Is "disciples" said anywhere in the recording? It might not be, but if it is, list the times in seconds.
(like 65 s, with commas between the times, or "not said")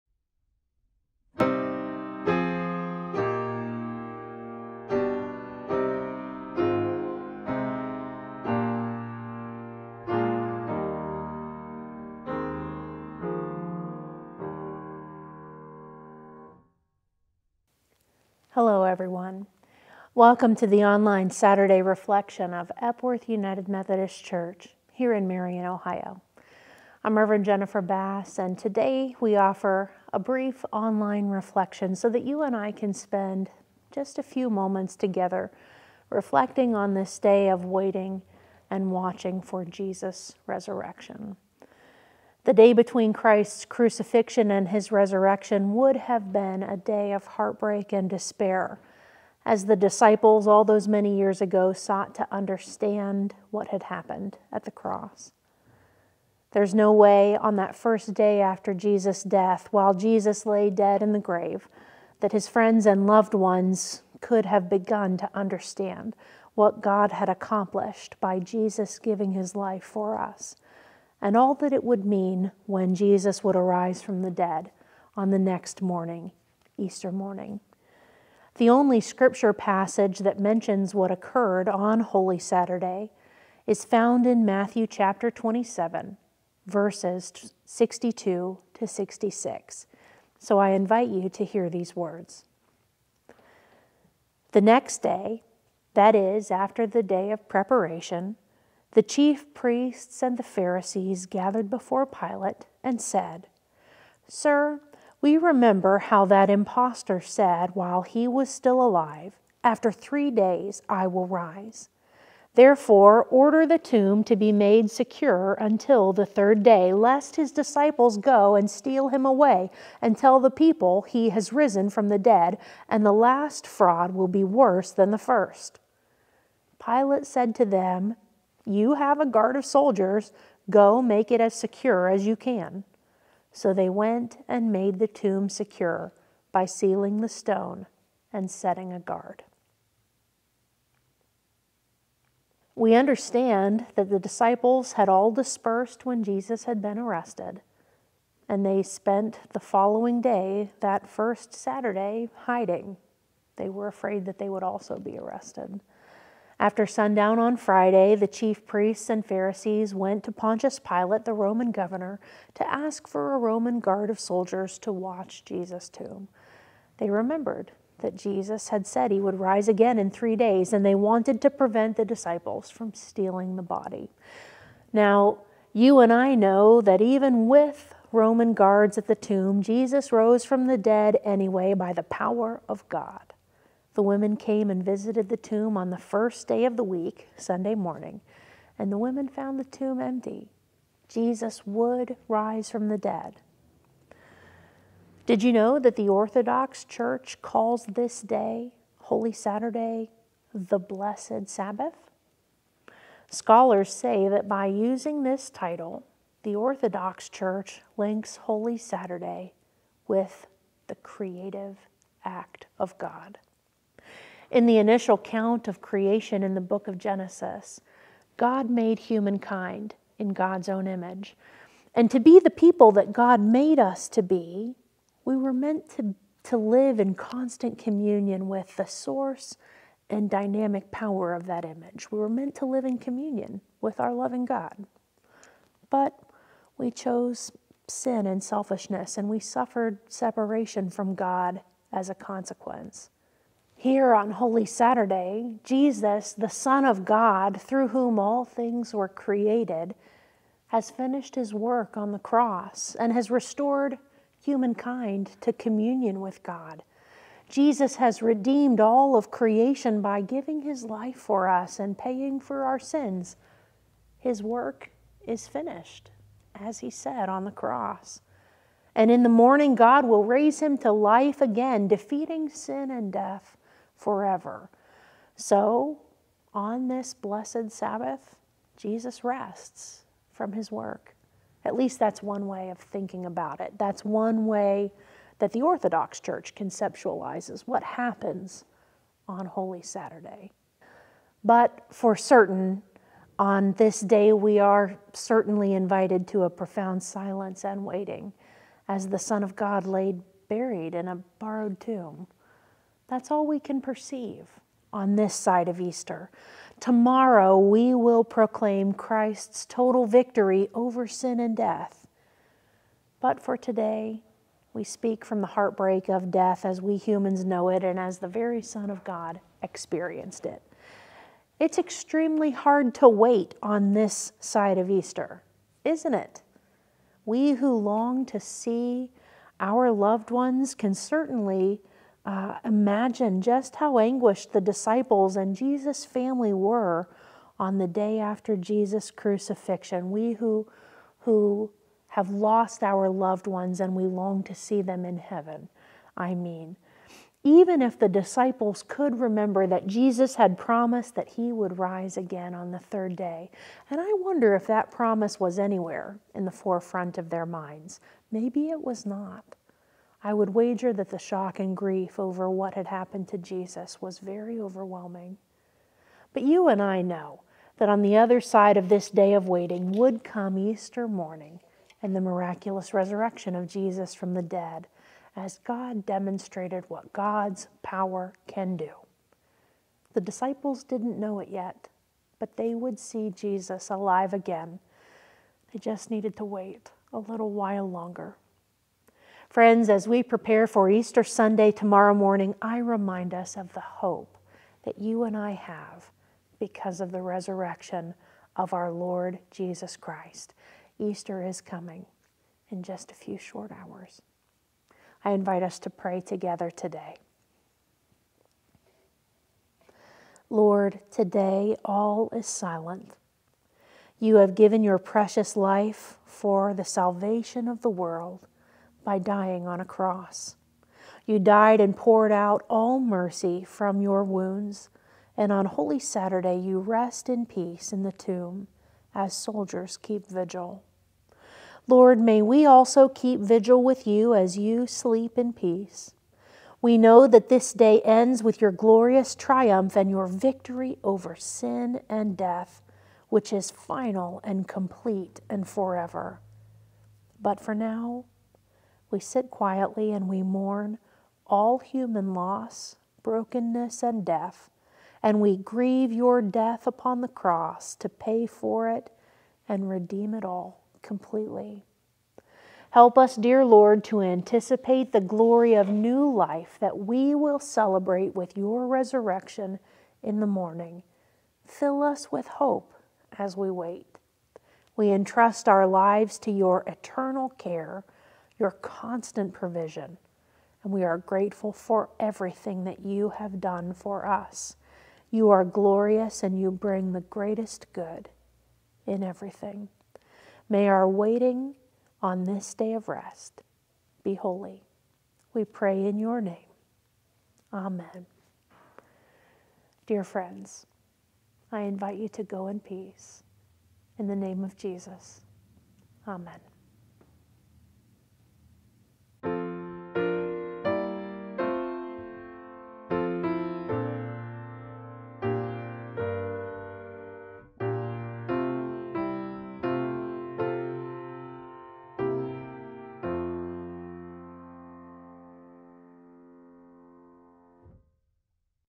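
49 s, 117 s, 144 s, 172 s, 334 s, 348 s, 380 s.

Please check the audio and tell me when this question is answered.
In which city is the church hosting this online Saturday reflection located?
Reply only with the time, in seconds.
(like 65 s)
25 s.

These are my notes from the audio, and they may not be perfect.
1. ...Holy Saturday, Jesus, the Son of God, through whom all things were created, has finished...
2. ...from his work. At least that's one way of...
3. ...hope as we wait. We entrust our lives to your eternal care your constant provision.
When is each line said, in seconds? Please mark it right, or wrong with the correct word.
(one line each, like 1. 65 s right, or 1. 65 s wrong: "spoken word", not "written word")
1. 244 s right
2. 280 s right
3. 472 s right.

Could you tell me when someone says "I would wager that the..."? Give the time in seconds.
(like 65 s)
360 s.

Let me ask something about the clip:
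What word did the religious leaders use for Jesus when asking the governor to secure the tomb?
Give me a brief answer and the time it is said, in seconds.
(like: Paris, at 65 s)
impostor, at 106 s.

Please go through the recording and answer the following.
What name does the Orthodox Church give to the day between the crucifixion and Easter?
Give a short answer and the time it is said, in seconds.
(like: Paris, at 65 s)
the Blessed Sabbath, at 200 s.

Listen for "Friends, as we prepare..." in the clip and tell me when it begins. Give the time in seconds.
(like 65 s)
389 s.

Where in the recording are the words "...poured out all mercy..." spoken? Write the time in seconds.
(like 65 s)
421 s.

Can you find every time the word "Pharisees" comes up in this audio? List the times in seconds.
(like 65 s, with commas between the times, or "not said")
100 s, 159 s.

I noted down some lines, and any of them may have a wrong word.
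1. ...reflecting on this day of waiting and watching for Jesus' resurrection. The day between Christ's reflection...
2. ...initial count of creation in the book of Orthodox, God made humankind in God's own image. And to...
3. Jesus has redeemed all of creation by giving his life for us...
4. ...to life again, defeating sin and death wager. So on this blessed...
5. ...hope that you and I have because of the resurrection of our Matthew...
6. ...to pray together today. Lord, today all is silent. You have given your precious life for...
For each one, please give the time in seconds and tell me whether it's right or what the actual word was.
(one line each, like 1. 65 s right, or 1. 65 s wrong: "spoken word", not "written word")
1. 36 s wrong: "crucifixion", not "reflection"
2. 214 s wrong: "Genesis", not "Orthodox"
3. 257 s right
4. 270 s wrong: "forever", not "wager"
5. 393 s wrong: "Lord", not "Matthew"
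6. 405 s right.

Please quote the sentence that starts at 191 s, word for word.
Jesus would rise from the dead.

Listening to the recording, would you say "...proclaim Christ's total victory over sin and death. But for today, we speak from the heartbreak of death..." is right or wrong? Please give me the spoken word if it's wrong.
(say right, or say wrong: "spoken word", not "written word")
right.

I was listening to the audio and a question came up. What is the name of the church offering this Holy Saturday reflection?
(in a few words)
Epworth United Methodist Church.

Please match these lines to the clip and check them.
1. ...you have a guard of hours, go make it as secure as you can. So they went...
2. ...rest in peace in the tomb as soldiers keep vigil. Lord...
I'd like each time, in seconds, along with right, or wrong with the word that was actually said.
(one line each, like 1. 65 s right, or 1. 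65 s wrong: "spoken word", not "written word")
1. 128 s wrong: "soldiers", not "hours"
2. 426 s right.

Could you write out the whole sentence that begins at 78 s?
The only scripture passage that mentions what occurred on Holy Saturday is found in Matthew chapter 27, verses 62 to 66.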